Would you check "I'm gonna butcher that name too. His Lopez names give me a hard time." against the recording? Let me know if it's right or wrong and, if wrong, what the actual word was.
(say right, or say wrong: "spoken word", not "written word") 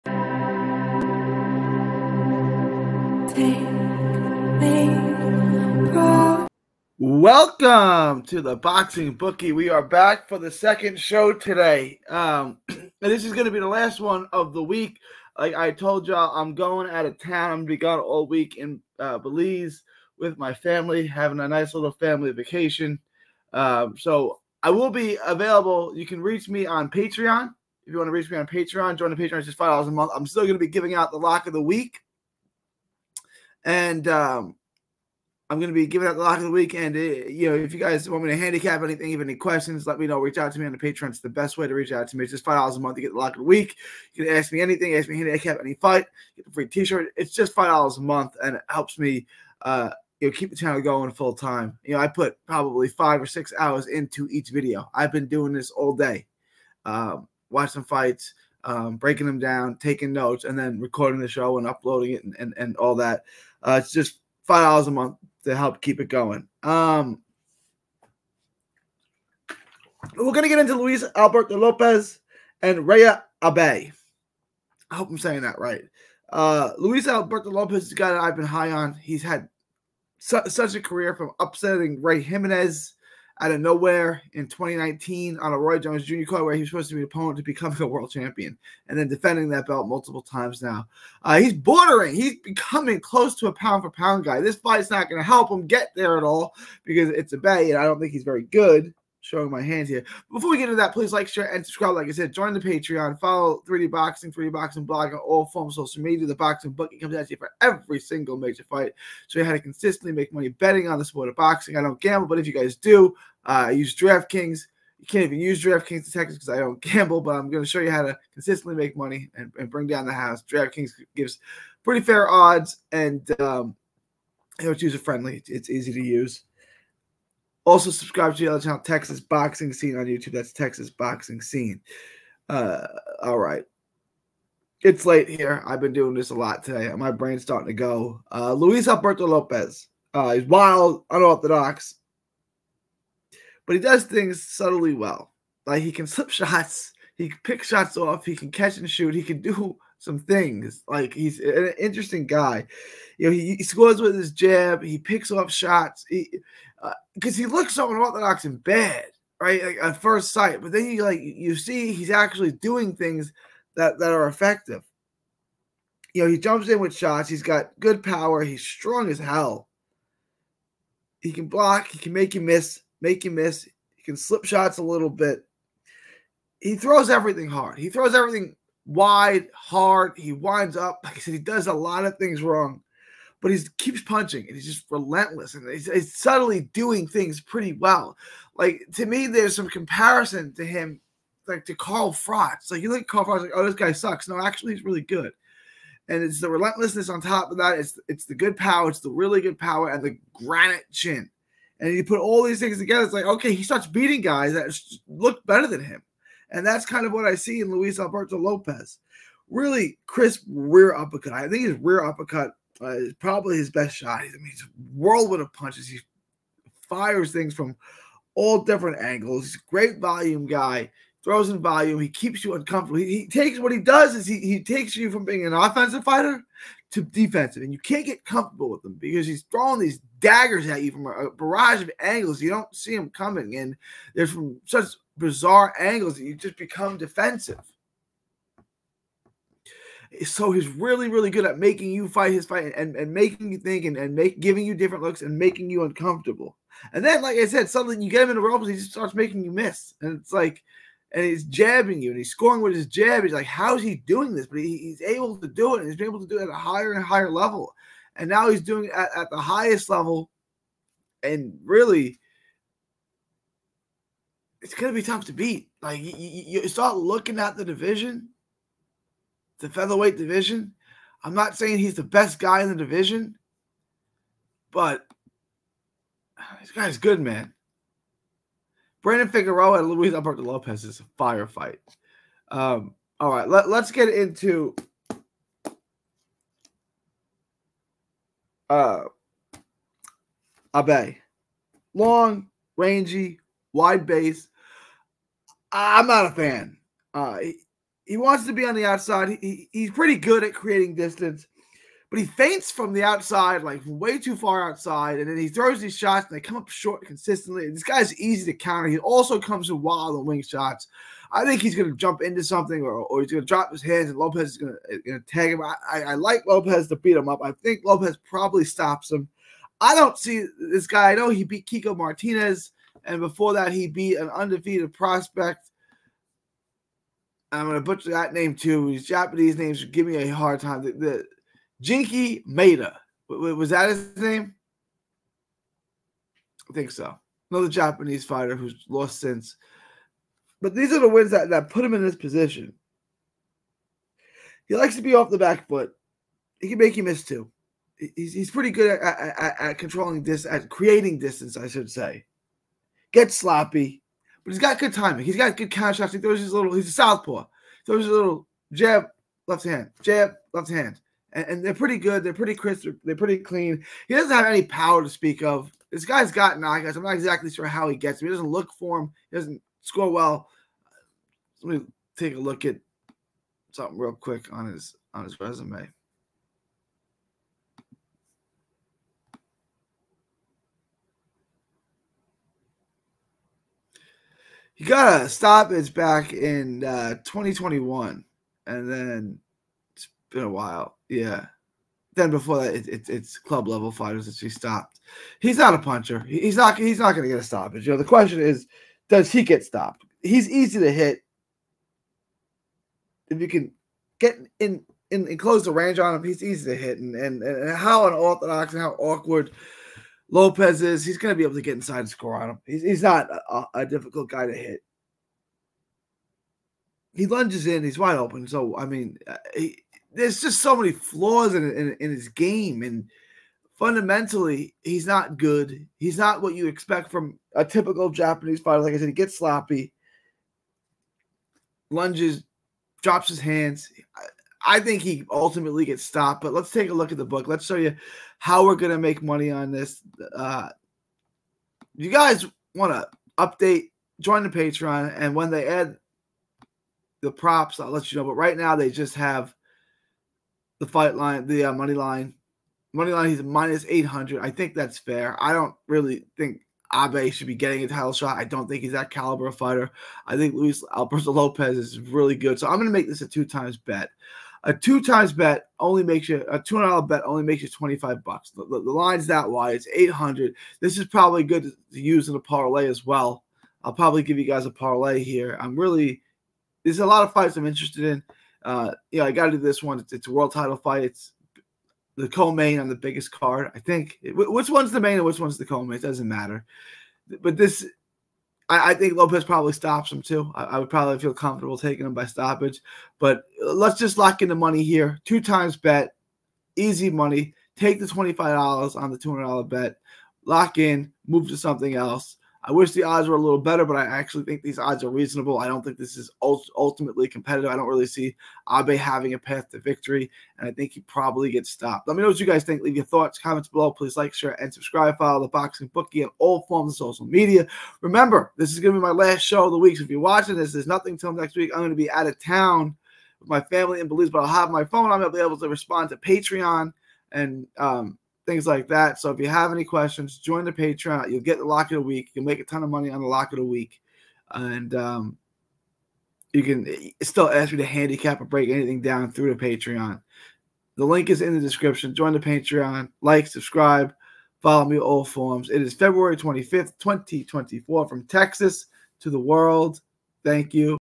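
wrong: "Japanese", not "Lopez".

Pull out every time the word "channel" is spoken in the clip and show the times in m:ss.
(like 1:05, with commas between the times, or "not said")
0:50, 2:08.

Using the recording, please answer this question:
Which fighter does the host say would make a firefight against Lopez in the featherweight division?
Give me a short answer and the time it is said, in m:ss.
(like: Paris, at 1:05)
Brandon Figueroa, at 4:39.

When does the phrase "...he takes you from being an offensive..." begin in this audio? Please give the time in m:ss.
3:44.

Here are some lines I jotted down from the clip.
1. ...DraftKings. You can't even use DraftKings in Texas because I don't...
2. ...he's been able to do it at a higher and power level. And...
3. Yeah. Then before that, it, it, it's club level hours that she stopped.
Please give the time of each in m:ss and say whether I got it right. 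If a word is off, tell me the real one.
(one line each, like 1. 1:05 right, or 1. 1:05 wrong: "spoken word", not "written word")
1. 1:53 right
2. 4:15 wrong: "higher", not "power"
3. 6:31 wrong: "fighters", not "hours".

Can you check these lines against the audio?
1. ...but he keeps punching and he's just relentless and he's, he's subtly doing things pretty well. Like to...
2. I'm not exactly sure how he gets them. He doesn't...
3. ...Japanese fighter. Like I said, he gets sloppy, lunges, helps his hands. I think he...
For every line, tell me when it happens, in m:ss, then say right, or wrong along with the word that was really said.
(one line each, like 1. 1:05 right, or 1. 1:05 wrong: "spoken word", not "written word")
1. 3:03 right
2. 6:06 right
3. 7:08 wrong: "drops", not "helps".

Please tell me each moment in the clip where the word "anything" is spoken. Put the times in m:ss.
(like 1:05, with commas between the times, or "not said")
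0:38, 0:44, 8:58.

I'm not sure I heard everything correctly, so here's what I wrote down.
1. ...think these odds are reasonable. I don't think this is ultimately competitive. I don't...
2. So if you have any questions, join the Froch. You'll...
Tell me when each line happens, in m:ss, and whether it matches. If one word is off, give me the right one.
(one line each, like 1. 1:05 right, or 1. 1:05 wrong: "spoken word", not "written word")
1. 8:24 right
2. 8:49 wrong: "Patreon", not "Froch".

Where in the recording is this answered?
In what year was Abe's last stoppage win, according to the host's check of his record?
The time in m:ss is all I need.
6:27.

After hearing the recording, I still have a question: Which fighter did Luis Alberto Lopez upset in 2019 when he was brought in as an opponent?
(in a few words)
Ray Jimenez.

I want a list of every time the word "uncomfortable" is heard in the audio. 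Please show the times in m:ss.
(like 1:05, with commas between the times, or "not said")
3:42, 4:05.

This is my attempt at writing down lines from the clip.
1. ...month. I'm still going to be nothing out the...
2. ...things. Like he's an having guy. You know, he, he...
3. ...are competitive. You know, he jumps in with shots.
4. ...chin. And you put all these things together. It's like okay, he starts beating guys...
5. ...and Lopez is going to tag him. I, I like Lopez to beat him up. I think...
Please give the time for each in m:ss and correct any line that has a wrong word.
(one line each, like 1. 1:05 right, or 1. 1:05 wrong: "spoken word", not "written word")
1. 0:29 wrong: "giving", not "nothing"
2. 2:30 wrong: "interesting", not "having"
3. 2:44 wrong: "effective", not "competitive"
4. 3:20 right
5. 5:14 right.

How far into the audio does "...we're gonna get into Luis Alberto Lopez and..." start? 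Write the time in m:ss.
1:10.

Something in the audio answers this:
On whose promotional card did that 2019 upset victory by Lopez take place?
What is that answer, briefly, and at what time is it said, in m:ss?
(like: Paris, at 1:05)
Roy Jones Jr., at 1:25.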